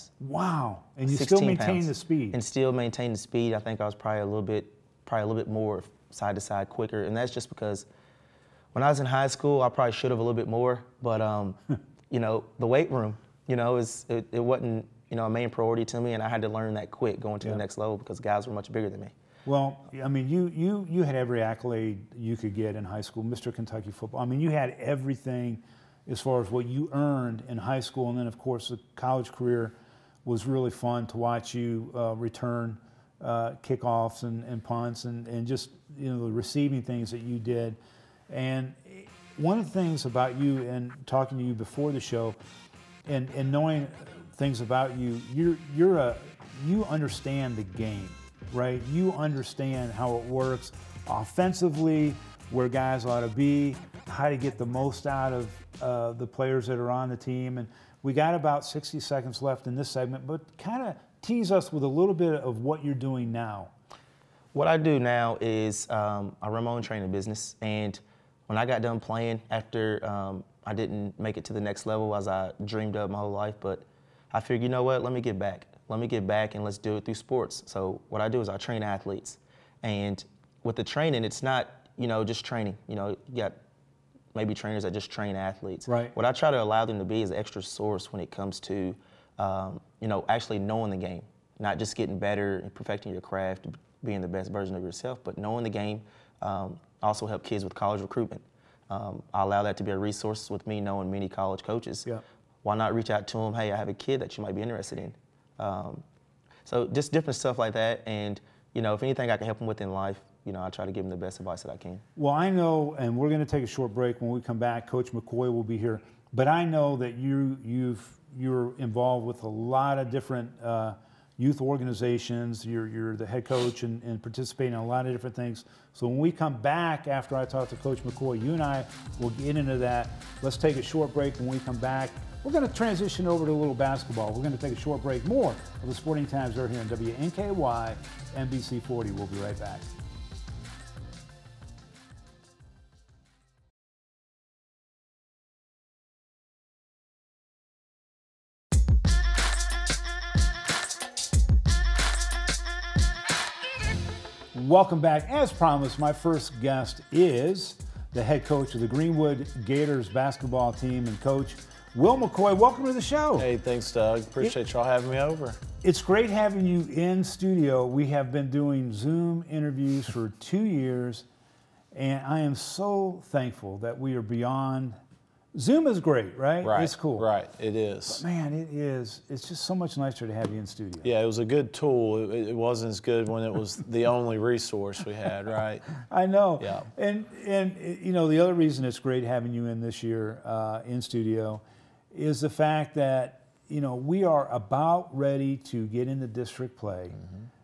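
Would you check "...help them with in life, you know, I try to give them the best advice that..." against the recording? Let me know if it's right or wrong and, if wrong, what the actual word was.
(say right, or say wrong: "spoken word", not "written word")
right.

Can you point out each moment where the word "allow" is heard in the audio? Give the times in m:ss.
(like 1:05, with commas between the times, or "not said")
1:26, 1:39.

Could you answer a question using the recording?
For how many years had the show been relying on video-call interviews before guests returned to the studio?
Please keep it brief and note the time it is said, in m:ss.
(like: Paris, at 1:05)
2, at 2:50.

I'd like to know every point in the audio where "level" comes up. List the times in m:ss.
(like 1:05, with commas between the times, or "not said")
0:17, 1:11.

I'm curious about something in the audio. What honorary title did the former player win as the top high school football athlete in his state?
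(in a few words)
Mr. Kentucky Football.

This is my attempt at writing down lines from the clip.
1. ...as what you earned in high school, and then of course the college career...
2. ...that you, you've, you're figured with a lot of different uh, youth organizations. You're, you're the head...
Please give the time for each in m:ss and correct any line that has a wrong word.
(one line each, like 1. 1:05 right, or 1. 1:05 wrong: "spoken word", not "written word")
1. 0:26 right
2. 1:56 wrong: "involved", not "figured".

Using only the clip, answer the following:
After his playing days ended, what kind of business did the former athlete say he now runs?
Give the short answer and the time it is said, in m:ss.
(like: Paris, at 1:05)
training business, at 1:06.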